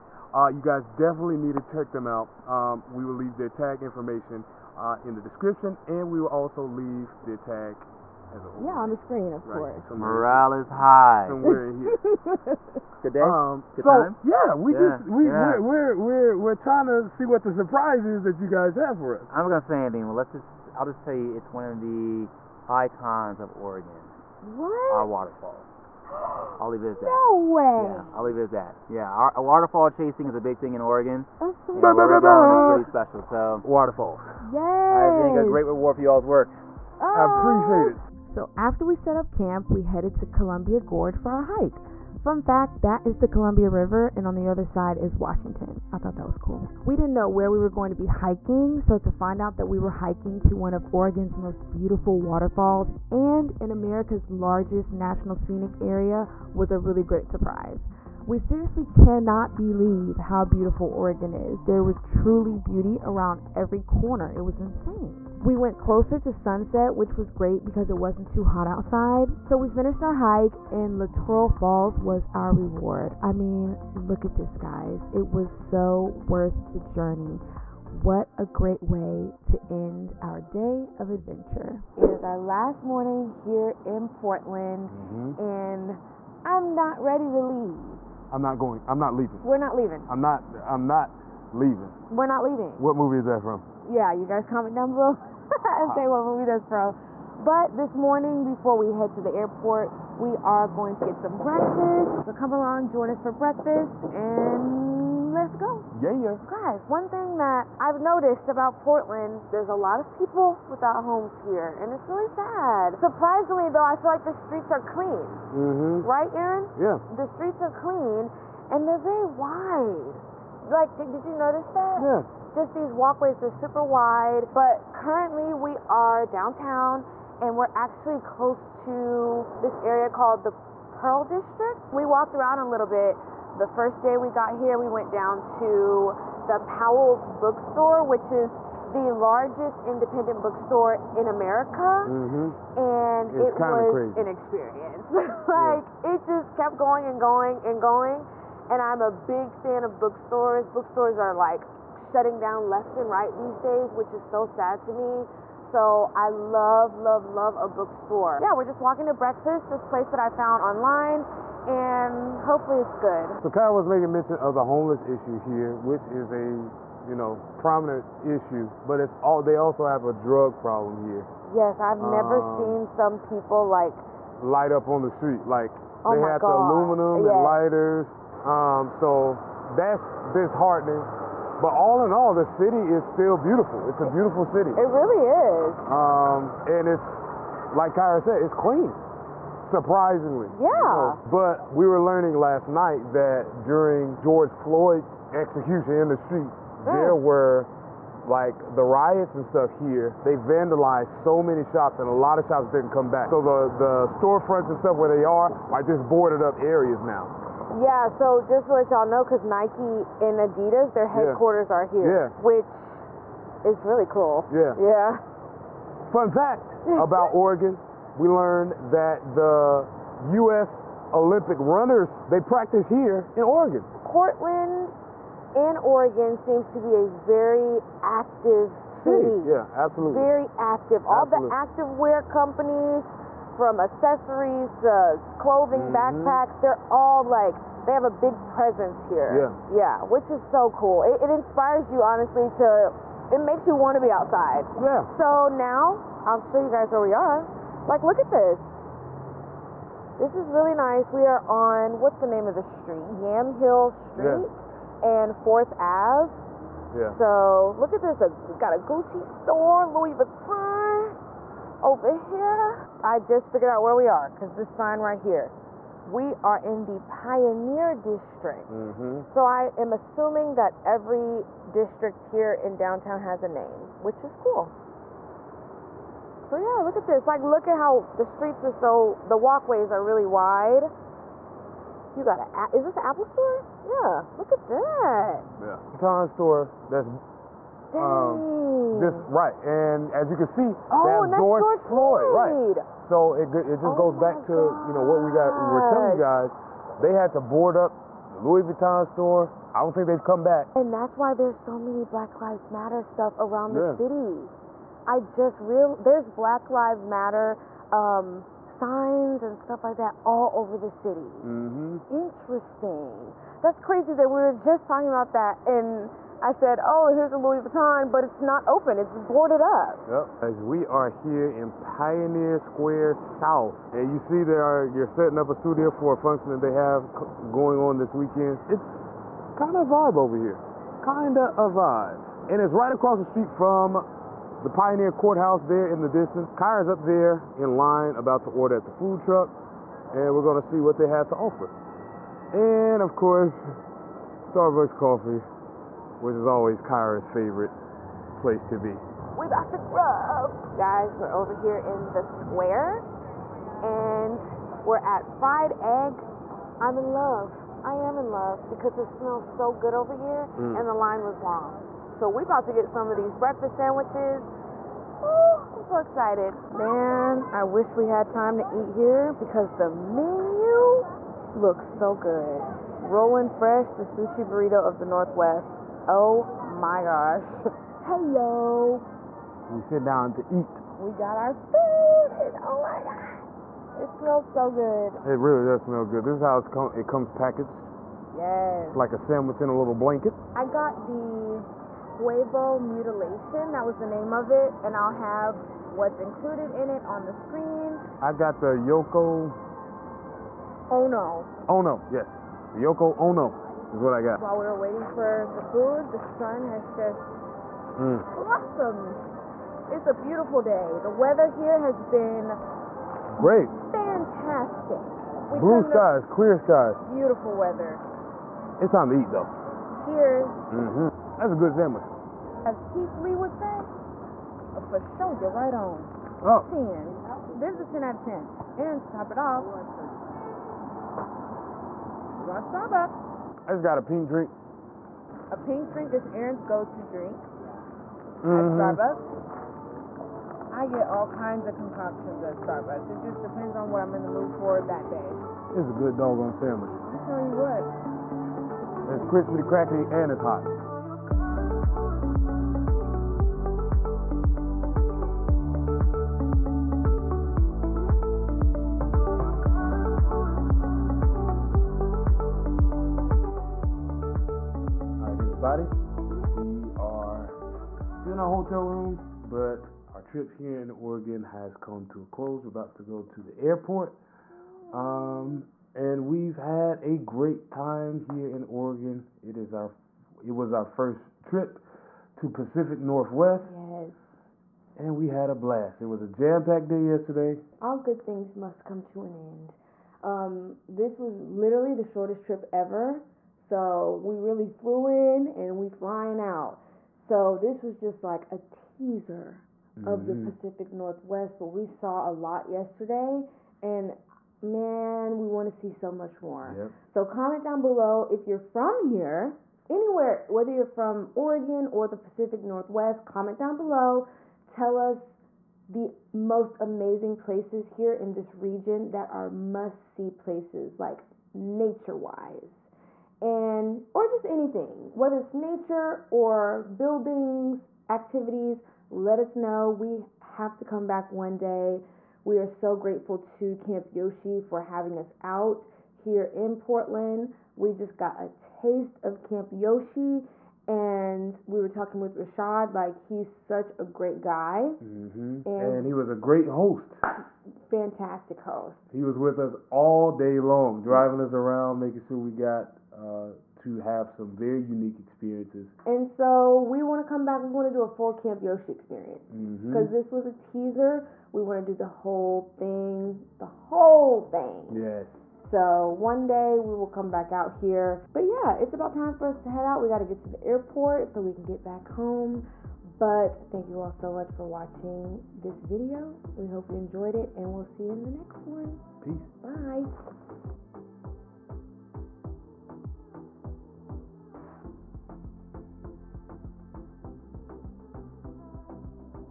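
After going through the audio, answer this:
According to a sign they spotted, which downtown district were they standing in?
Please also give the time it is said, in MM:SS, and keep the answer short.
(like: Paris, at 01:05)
Pioneer District, at 04:27.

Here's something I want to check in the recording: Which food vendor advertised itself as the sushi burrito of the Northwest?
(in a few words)
Rolling Fresh.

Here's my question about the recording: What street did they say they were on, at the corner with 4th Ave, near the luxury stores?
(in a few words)
Yamhill Street.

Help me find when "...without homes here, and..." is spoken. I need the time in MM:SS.
01:50.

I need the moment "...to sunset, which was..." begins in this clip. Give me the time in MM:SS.
01:06.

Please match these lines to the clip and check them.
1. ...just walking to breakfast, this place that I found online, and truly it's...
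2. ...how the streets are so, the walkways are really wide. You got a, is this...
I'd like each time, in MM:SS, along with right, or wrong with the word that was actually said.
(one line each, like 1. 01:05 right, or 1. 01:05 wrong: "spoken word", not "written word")
1. 02:38 wrong: "hopefully", not "truly"
2. 04:37 right.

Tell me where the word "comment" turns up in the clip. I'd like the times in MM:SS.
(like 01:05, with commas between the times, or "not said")
01:34, 08:27, 08:33.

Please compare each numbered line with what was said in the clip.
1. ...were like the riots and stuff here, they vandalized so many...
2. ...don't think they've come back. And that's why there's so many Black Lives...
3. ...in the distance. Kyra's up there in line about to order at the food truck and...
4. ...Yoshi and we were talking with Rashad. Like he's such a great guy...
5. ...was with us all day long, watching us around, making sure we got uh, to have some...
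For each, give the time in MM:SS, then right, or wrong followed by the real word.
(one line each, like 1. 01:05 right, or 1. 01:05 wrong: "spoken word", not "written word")
1. 03:17 right
2. 04:59 right
3. 05:35 right
4. 08:59 right
5. 09:09 wrong: "driving", not "watching".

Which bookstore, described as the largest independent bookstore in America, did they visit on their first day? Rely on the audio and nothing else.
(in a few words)
Powell's Bookstore.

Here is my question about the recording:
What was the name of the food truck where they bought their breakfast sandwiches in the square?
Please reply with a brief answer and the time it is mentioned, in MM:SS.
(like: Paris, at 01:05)
Fried Egg, at 05:55.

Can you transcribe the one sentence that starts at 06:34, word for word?
And I'll have what's included in it on the screen.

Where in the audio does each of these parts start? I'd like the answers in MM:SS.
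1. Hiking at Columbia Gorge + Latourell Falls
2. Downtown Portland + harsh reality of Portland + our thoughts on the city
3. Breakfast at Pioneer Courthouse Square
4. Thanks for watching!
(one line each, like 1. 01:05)
1. 00:37
2. 01:19
3. 05:19
4. 09:28.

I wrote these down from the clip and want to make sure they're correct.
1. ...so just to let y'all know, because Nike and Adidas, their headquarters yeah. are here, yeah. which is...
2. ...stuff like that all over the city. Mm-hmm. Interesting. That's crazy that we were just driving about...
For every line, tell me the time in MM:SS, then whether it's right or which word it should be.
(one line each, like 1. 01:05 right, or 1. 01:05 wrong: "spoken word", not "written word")
1. 03:28 right
2. 05:09 wrong: "talking", not "driving".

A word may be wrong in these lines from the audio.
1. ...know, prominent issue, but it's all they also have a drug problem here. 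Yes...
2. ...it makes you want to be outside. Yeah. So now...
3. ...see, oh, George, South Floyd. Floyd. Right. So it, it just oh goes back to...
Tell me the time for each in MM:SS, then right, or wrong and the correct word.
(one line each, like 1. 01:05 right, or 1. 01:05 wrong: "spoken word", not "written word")
1. 02:47 right
2. 04:03 right
3. 04:50 wrong: "George", not "South".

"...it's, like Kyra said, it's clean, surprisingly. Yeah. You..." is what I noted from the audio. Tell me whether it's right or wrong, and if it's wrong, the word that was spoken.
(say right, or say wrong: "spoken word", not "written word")
right.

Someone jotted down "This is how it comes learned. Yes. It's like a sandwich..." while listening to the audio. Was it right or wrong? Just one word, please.
wrong.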